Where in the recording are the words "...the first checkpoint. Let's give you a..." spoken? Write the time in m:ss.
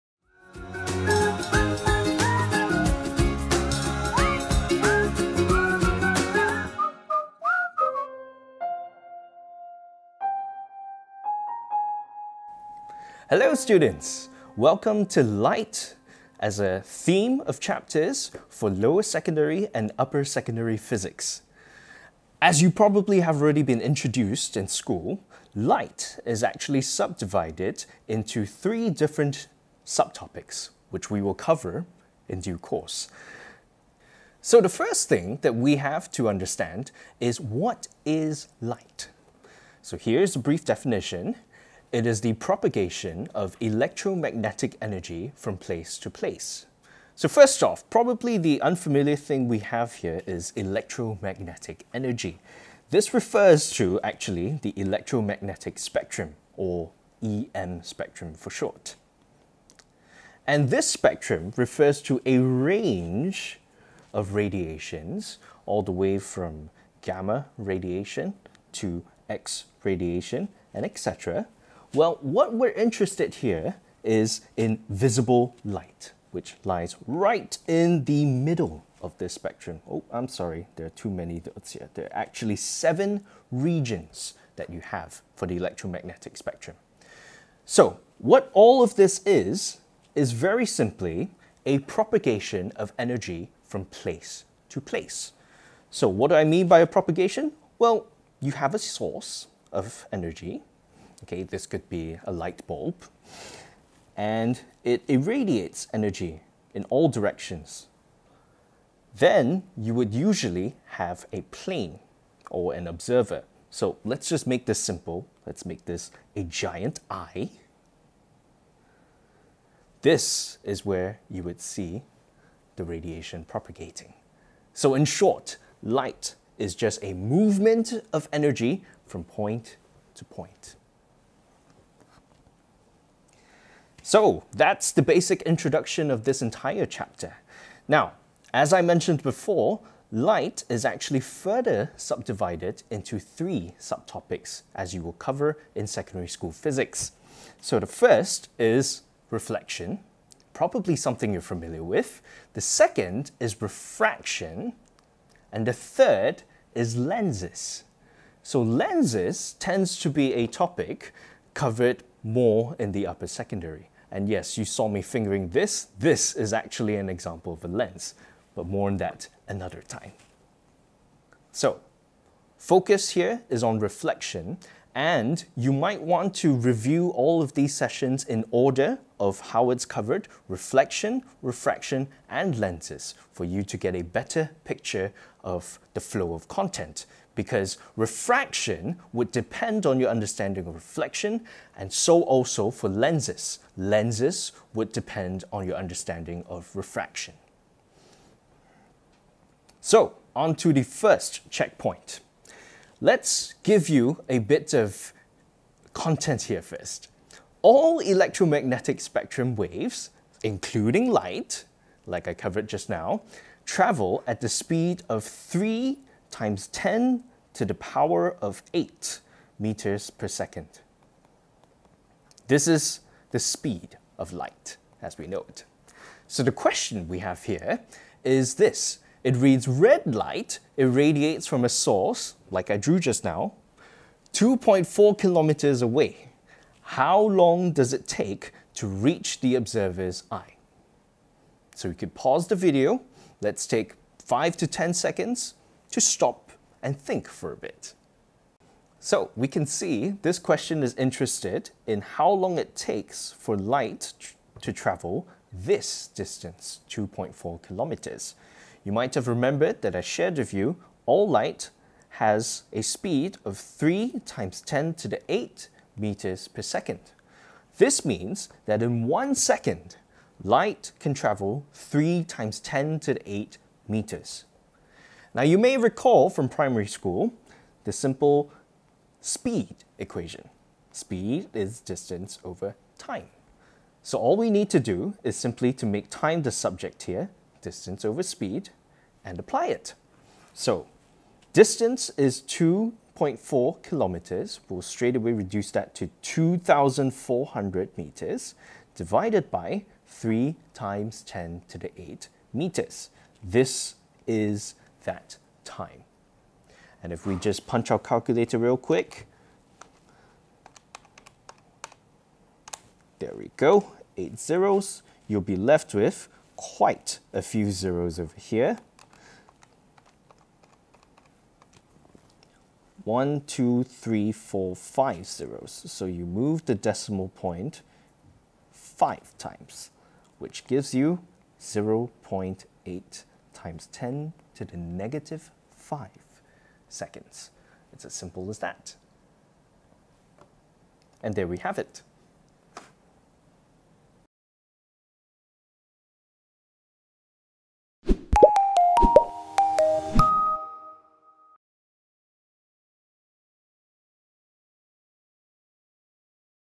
3:20.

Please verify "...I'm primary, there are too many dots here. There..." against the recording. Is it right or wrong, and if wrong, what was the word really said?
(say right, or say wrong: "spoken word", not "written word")
wrong: "sorry", not "primary".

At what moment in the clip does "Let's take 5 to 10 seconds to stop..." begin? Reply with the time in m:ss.
4:03.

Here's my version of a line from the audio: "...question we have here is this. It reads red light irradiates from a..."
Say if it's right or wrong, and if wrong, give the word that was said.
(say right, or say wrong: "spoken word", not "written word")
right.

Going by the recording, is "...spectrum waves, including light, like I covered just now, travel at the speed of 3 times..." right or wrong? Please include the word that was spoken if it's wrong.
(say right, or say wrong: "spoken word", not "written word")
right.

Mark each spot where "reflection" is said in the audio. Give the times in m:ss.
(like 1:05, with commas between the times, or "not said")
2:29, 2:53, 3:00, 3:10.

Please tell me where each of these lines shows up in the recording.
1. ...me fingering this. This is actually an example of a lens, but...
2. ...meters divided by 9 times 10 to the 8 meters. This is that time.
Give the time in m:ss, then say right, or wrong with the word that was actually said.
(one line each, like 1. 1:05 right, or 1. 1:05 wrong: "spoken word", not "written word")
1. 2:44 right
2. 4:57 wrong: "3", not "9".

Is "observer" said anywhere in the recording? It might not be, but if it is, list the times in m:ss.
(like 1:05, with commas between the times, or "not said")
1:52, 3:59.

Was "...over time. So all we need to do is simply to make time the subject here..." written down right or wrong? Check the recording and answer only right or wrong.
right.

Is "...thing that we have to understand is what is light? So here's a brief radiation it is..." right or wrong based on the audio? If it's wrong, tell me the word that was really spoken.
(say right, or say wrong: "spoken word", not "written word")
wrong: "definition", not "radiation".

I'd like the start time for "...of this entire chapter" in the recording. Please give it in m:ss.
2:16.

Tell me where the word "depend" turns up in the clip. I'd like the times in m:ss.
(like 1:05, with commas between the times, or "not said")
3:09, 3:14.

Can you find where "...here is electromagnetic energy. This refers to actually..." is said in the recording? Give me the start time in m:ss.
0:49.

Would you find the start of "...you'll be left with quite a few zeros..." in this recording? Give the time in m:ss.
5:15.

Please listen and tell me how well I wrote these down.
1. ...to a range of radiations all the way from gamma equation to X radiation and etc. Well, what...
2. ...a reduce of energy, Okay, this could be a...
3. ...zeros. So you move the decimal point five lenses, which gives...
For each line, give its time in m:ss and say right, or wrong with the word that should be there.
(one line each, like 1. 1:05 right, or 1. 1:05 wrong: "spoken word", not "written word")
1. 1:02 wrong: "radiation", not "equation"
2. 1:38 wrong: "source", not "reduce"
3. 5:25 wrong: "times", not "lenses".